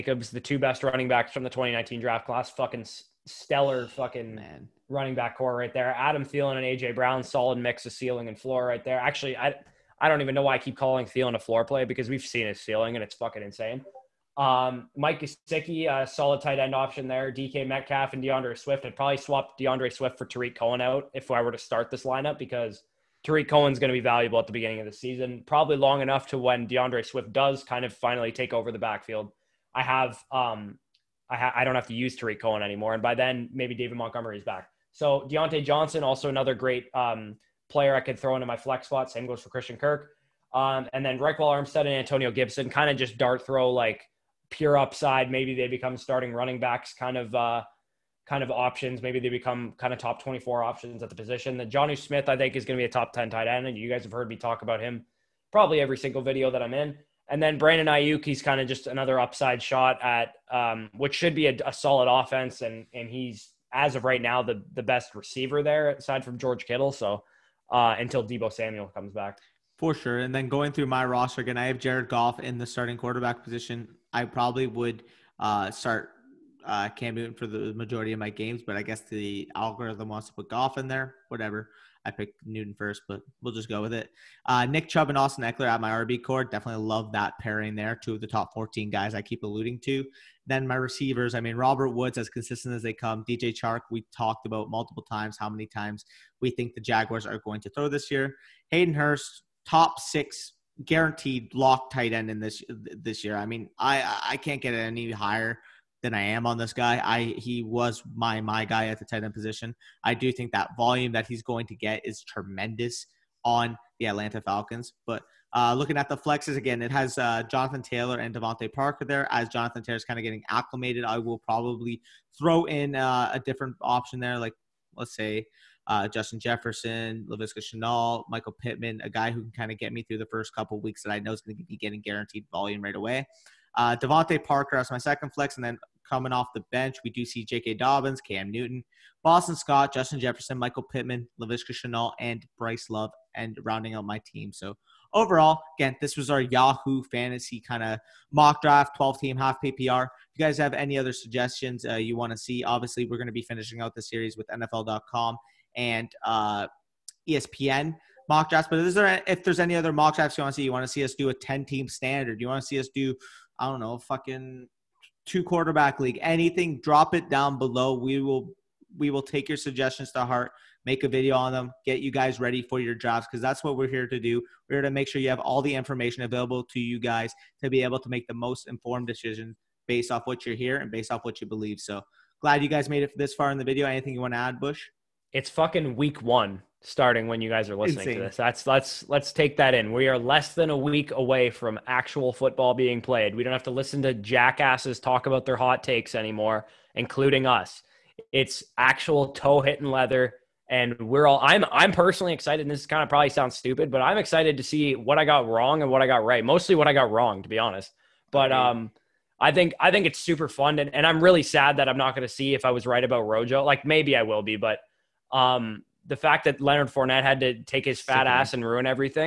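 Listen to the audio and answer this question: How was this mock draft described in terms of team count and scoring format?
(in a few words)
12 team half PPR.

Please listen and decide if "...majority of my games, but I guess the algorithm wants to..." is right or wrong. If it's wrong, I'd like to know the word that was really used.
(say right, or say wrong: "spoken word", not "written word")
right.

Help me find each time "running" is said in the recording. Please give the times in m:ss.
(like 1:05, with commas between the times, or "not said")
0:00, 0:04, 0:46.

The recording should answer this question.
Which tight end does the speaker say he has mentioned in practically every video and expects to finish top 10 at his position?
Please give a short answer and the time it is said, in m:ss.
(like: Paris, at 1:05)
Jonnu Smith, at 0:51.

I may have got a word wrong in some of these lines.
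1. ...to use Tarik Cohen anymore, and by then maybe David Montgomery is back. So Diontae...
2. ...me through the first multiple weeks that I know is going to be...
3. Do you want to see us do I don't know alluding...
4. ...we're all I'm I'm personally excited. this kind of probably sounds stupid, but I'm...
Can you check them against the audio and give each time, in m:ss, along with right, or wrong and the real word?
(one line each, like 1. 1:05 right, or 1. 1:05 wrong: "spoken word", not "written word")
1. 0:31 right
2. 2:09 wrong: "couple", not "multiple"
3. 2:42 wrong: "fucking", not "alluding"
4. 3:20 right.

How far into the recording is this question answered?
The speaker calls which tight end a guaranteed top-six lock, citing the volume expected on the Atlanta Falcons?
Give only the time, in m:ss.
1:38.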